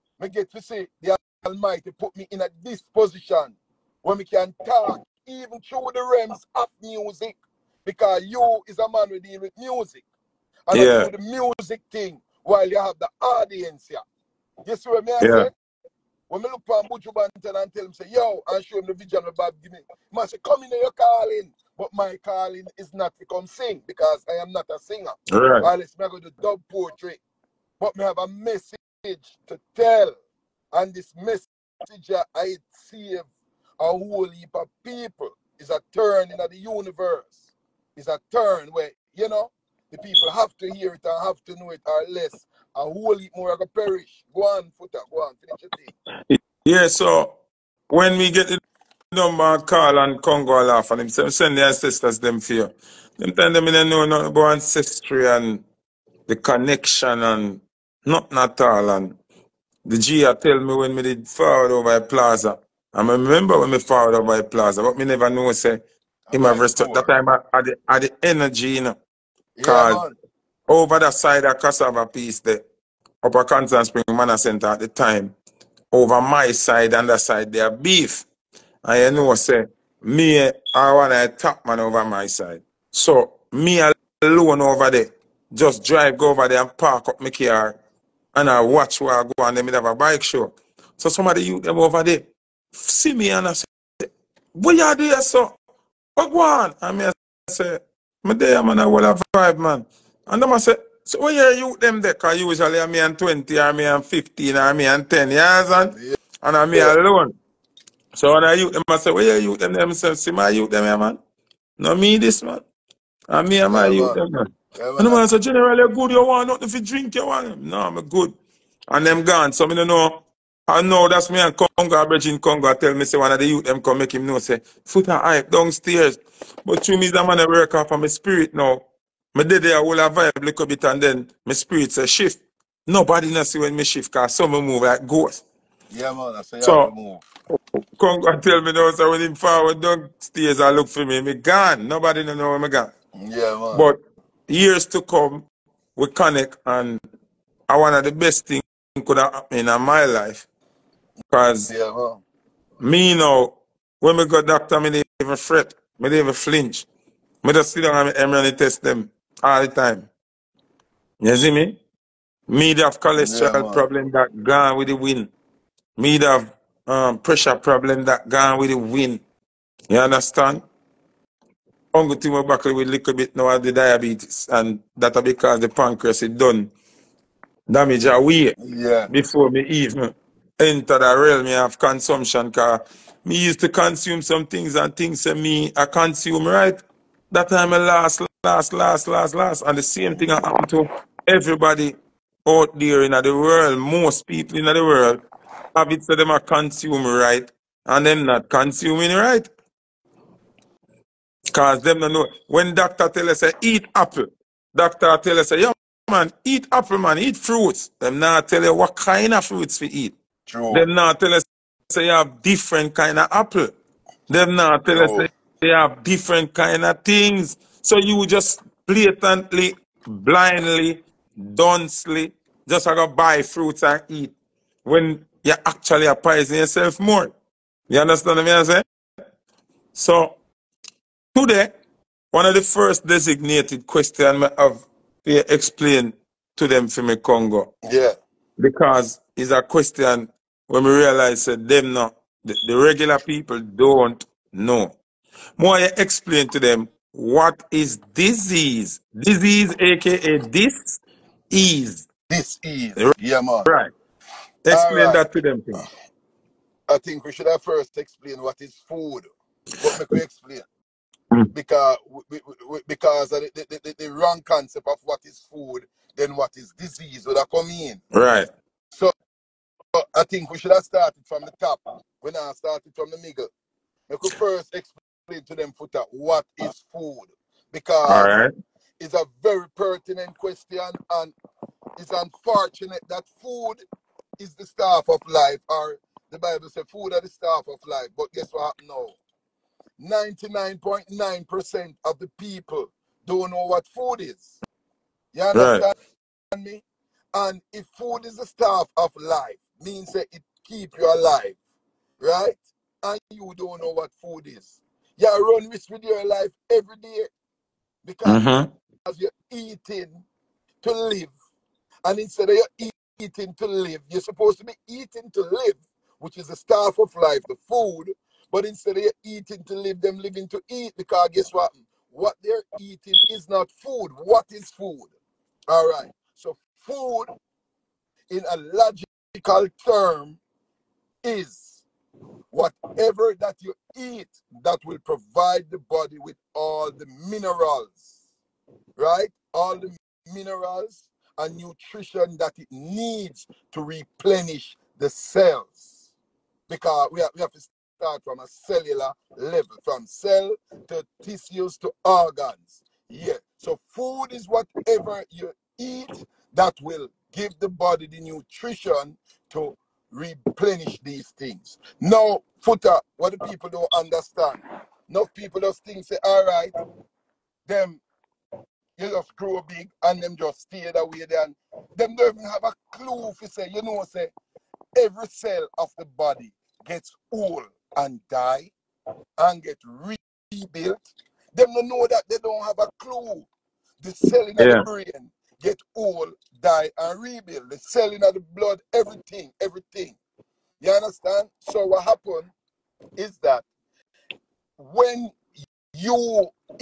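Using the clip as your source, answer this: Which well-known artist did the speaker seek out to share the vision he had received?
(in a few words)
Buju Banton.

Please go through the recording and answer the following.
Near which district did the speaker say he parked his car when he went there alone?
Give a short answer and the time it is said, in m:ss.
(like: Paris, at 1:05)
Cassava Piece, at 1:11.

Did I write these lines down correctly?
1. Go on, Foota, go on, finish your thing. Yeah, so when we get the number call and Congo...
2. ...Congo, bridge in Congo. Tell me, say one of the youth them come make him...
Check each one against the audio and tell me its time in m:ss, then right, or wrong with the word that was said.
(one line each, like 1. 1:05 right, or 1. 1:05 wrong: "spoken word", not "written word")
1. 0:44 right
2. 2:01 right.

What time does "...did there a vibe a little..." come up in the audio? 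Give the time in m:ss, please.
2:09.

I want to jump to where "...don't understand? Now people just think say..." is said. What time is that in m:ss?
6:03.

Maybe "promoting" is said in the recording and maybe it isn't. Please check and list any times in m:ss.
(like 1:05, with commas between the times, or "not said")
not said.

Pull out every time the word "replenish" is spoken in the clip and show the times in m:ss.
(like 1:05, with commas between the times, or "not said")
5:43, 6:00.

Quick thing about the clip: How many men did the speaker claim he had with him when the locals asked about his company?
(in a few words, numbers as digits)
5.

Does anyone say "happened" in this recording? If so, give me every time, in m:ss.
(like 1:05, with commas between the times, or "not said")
2:29, 3:10, 4:48, 6:32.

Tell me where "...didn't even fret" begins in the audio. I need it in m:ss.
2:34.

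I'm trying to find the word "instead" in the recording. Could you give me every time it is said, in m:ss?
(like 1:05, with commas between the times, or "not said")
5:12, 5:18.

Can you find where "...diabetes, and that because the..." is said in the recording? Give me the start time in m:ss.
2:53.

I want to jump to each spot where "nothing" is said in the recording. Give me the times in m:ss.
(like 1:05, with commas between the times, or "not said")
0:54, 0:58, 1:56.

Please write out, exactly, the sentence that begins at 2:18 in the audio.
Come and tell me now, so when him forward as I look for me, me gone.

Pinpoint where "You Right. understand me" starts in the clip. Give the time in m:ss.
4:55.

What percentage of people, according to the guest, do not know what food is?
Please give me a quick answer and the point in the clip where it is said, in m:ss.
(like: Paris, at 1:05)
99.9%, at 4:50.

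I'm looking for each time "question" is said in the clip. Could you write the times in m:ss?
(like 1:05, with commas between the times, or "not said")
3:53, 3:59, 4:40.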